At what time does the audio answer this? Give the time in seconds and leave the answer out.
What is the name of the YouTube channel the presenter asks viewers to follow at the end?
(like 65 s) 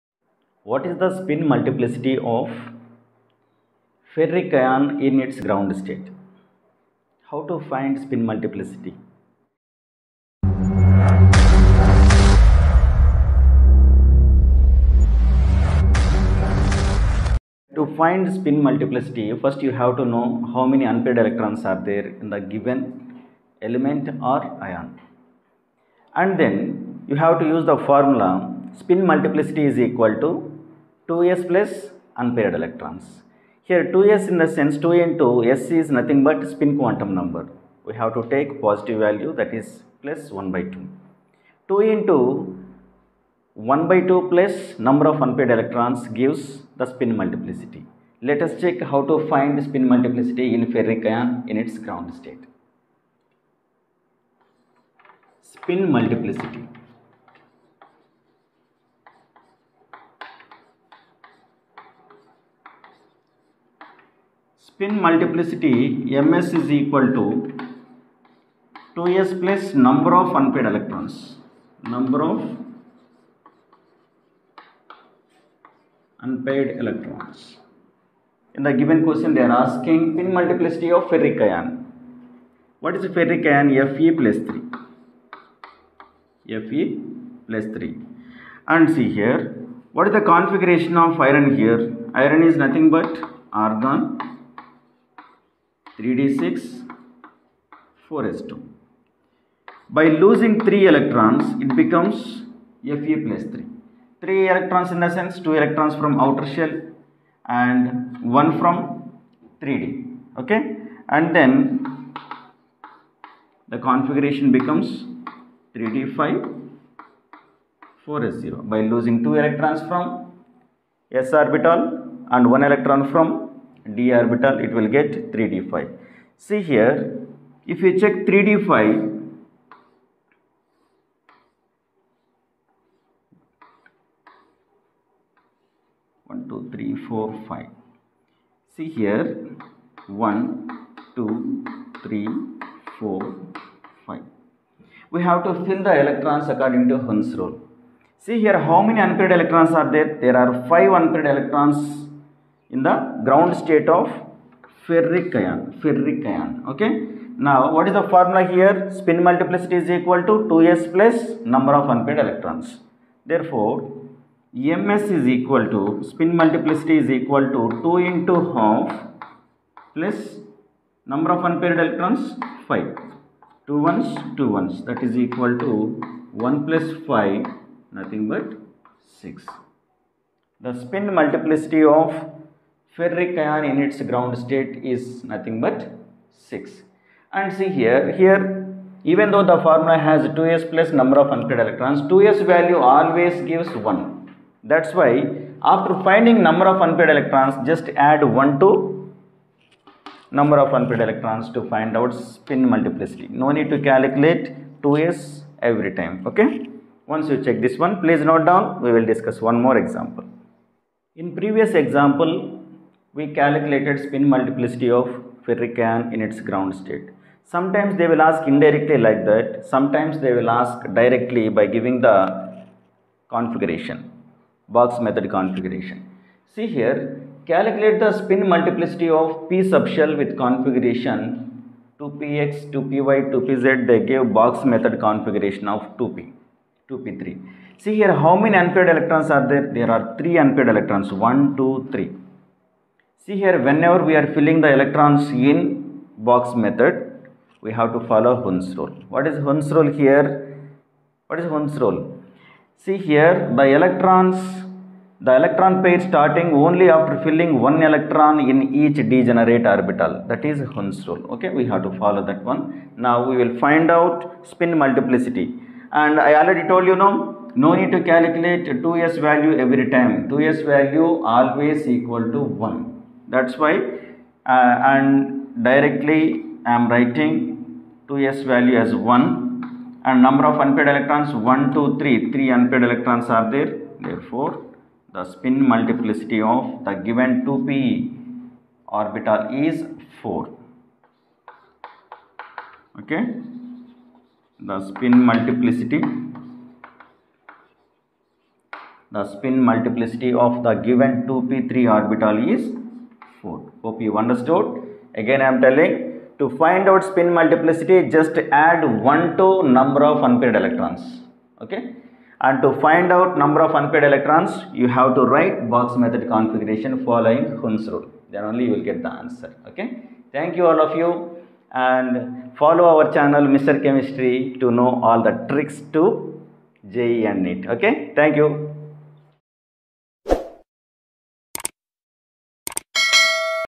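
323 s.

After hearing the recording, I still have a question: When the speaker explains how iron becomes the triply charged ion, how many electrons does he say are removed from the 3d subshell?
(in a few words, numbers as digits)
1.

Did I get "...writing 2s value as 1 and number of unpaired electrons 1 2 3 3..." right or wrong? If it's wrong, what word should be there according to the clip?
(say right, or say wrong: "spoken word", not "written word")
right.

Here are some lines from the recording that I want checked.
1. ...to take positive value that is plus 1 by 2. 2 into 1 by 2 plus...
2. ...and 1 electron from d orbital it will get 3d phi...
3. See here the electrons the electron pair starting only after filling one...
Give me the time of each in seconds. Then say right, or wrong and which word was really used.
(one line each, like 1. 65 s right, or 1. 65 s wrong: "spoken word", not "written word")
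1. 38 s right
2. 122 s right
3. 252 s right.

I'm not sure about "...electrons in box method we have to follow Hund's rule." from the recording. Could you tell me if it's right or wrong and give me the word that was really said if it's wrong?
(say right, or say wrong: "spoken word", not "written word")
right.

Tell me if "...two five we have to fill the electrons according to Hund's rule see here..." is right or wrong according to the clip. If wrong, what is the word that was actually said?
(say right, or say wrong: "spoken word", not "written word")
wrong: "four", not "two".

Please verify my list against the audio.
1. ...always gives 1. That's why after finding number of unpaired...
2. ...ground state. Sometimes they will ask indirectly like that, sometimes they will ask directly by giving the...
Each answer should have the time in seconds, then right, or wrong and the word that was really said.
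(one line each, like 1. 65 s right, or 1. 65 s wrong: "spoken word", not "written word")
1. 192 s right
2. 216 s right.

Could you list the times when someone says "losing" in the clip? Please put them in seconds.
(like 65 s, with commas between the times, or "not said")
100 s, 118 s.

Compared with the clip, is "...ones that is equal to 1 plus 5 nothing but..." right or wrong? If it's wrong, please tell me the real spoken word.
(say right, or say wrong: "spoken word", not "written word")
right.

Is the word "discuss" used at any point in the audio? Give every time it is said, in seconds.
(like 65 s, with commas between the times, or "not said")
209 s.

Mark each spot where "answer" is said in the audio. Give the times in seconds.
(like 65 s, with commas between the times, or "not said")
319 s.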